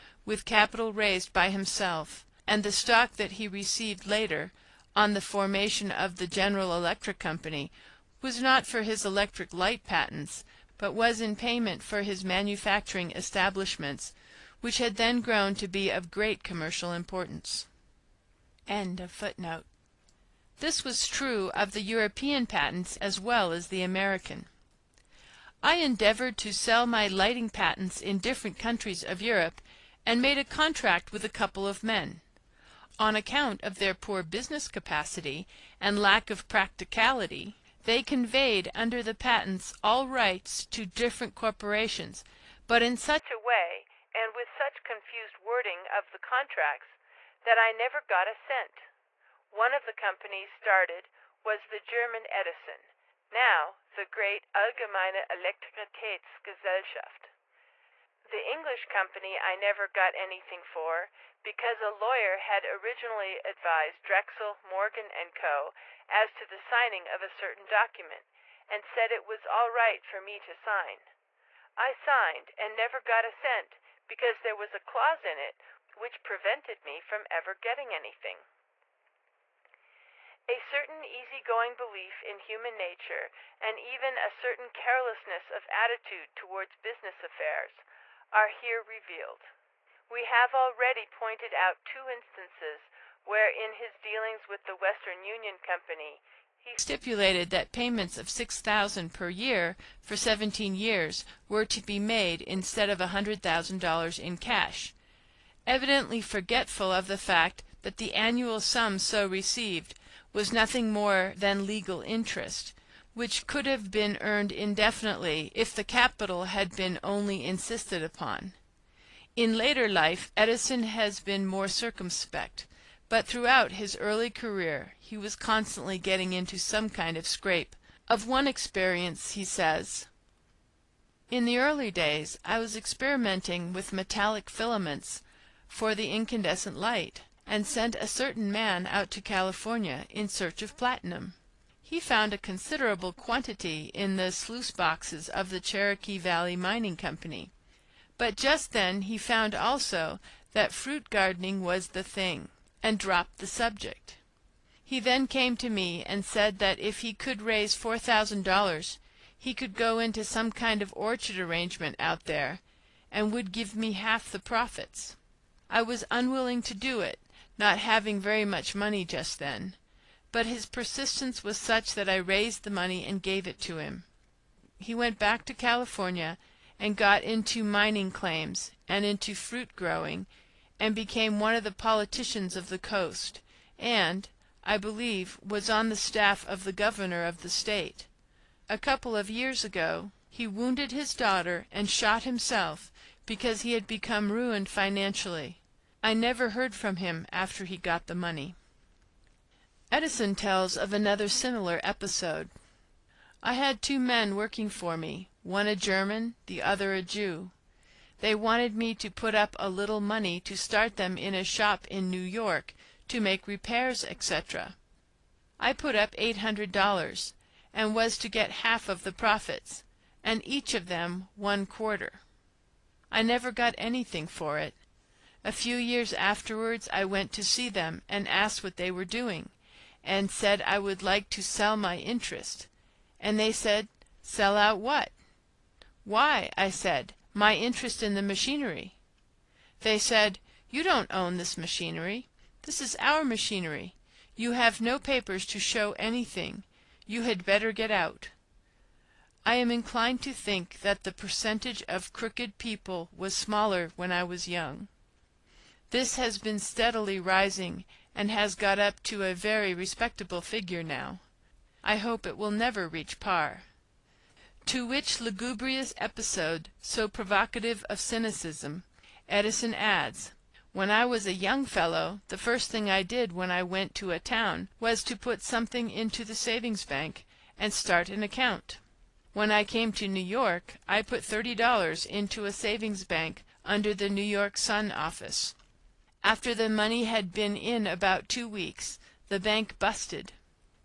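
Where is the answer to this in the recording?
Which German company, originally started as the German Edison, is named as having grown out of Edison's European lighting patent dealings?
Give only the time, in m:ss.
0:54.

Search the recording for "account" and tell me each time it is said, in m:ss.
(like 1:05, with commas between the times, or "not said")
0:33, 4:38.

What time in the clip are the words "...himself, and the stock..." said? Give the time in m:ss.
0:01.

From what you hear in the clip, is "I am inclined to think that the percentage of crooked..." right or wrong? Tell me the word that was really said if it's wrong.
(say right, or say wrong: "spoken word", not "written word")
right.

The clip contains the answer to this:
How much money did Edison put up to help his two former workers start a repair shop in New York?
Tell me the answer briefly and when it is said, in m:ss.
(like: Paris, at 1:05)
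$800, at 3:36.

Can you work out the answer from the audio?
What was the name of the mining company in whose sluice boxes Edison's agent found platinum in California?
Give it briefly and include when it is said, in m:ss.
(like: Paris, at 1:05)
Cherokee Valley Mining Company, at 2:25.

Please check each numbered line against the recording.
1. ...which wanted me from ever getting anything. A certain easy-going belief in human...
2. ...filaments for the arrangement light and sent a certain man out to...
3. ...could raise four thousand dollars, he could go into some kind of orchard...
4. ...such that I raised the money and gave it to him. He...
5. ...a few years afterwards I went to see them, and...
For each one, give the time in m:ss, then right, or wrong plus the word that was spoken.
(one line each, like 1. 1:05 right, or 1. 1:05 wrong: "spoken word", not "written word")
1. 1:15 wrong: "prevented", not "wanted"
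2. 2:14 wrong: "incandescent", not "arrangement"
3. 2:37 right
4. 2:51 right
5. 3:45 right.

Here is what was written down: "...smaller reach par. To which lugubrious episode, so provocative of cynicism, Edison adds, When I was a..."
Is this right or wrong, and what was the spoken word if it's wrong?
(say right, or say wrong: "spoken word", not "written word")
wrong: "never", not "smaller".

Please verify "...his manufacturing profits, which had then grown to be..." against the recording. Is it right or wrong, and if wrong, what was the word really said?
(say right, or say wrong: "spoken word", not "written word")
wrong: "establishments", not "profits".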